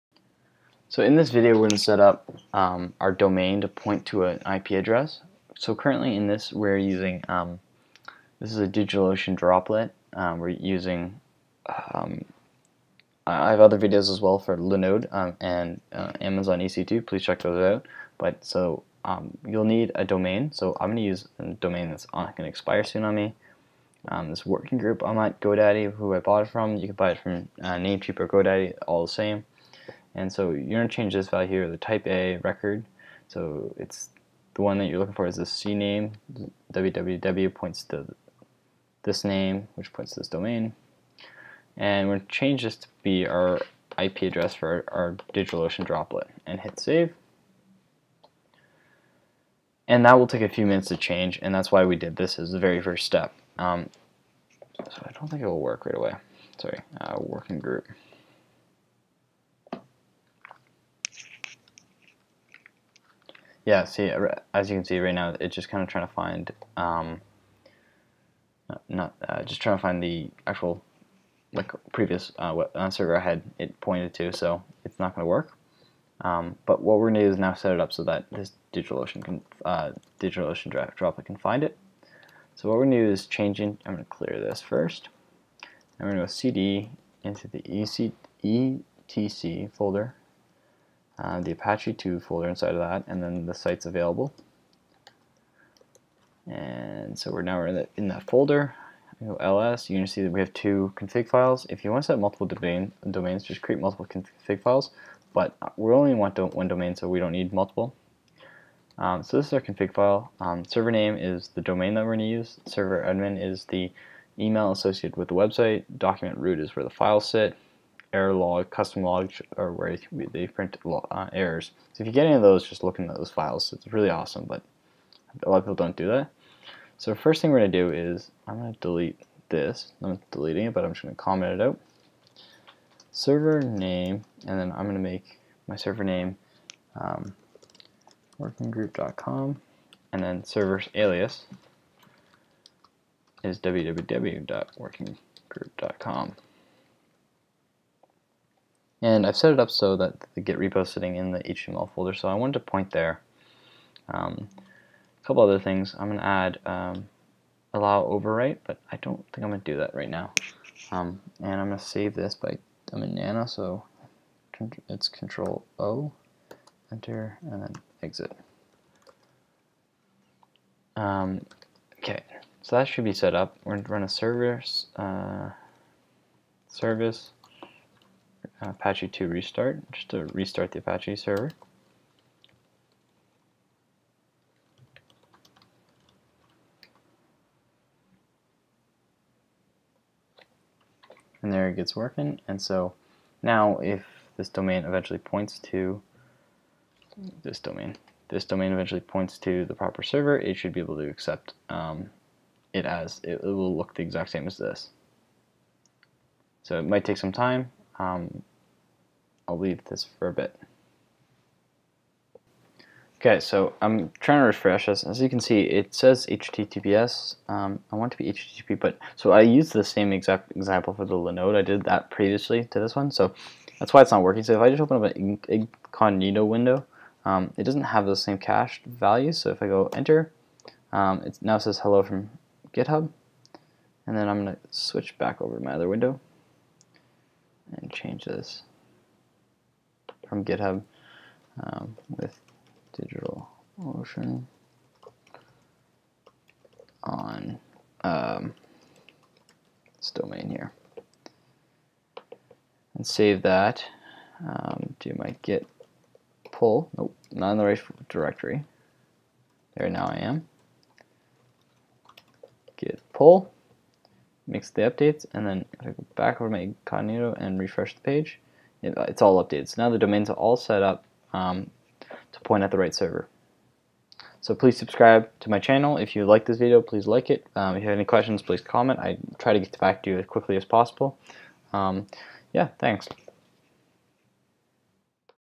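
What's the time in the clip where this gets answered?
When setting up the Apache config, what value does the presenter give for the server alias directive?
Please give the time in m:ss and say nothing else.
2:23.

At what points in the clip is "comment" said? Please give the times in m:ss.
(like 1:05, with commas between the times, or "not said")
2:11, 4:38.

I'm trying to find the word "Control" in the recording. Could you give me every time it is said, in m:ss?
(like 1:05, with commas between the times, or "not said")
2:45.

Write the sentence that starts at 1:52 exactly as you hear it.
Server admin is the email associated with the website.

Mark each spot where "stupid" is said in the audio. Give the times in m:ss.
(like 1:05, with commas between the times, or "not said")
not said.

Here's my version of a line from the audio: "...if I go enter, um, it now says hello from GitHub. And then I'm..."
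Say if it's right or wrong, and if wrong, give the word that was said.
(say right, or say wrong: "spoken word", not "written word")
right.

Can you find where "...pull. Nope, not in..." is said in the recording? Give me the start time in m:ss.
4:16.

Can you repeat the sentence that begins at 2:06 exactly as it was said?
So first thing we're going to do is I'm going to delete this.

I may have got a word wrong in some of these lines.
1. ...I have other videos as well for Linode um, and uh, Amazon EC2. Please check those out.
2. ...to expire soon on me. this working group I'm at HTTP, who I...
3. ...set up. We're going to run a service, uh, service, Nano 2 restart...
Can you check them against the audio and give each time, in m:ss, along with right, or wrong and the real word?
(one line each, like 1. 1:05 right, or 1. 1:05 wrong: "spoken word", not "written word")
1. 0:13 right
2. 0:22 wrong: "GoDaddy", not "HTTP"
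3. 2:53 wrong: "Apache", not "Nano".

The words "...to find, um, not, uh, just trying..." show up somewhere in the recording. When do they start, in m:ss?
1:06.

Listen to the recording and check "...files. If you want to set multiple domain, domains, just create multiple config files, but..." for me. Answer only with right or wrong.
right.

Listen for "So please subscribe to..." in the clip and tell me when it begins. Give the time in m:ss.
4:34.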